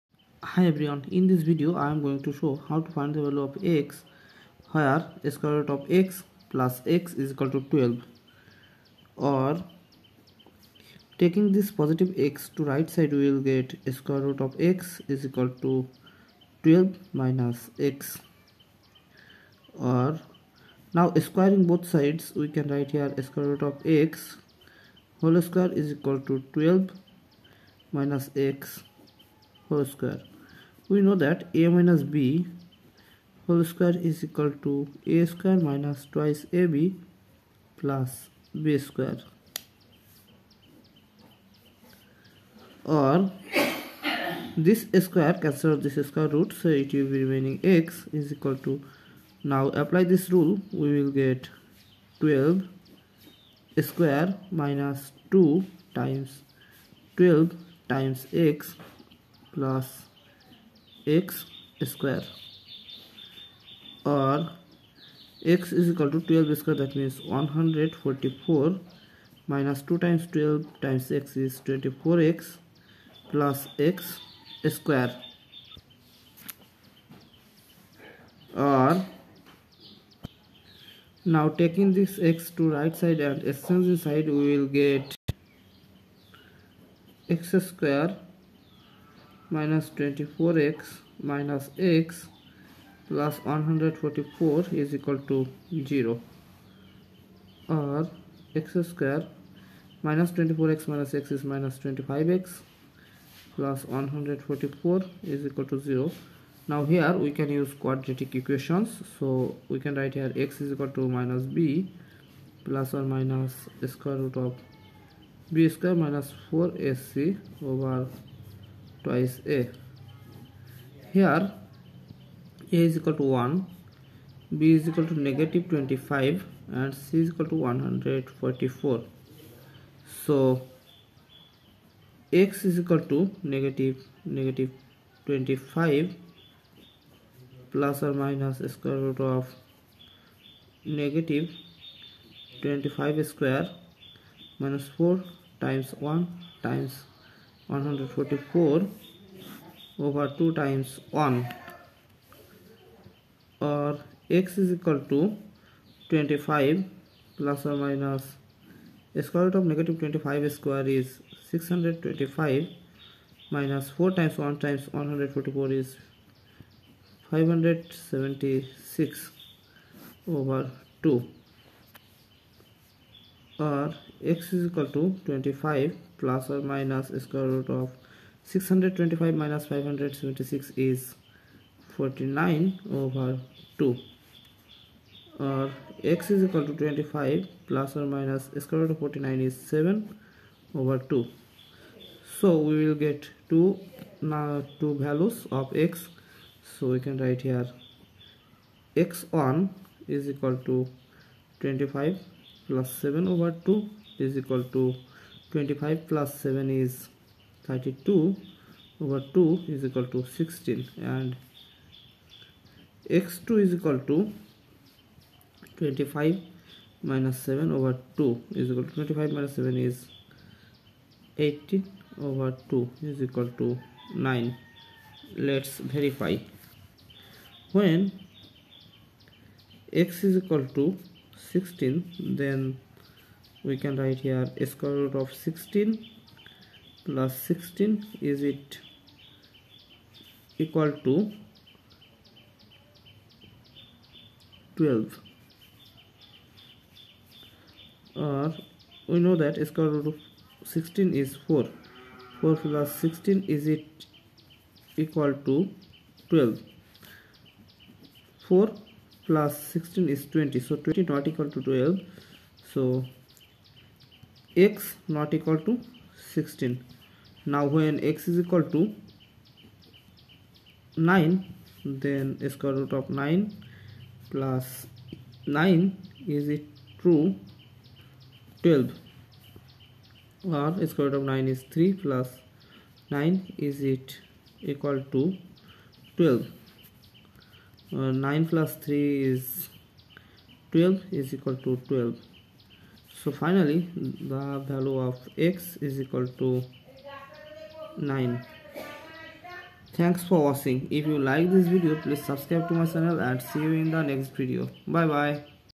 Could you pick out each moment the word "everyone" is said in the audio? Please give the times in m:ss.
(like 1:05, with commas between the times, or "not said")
0:00.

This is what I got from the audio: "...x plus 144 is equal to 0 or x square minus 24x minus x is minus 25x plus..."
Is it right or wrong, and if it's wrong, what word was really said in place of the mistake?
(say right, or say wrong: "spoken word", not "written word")
right.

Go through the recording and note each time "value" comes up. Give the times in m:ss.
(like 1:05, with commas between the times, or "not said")
0:03, 3:15, 4:54.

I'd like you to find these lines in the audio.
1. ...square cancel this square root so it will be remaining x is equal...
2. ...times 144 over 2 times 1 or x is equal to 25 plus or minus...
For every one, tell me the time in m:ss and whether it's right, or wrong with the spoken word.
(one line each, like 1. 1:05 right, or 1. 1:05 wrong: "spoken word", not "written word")
1. 0:45 right
2. 2:26 right.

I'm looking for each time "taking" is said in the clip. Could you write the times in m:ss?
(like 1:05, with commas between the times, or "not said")
0:11, 1:21.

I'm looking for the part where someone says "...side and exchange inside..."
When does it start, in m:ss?
1:22.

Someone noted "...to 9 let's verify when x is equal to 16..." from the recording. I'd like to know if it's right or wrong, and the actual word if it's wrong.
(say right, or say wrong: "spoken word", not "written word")
right.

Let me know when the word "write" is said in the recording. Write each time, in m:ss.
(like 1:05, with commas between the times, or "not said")
0:22, 1:49, 3:17, 3:54.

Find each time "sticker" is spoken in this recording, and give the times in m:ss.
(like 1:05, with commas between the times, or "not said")
not said.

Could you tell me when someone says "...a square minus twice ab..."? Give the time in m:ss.
0:35.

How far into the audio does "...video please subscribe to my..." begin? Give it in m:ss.
5:01.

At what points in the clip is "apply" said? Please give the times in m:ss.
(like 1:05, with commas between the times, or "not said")
0:49.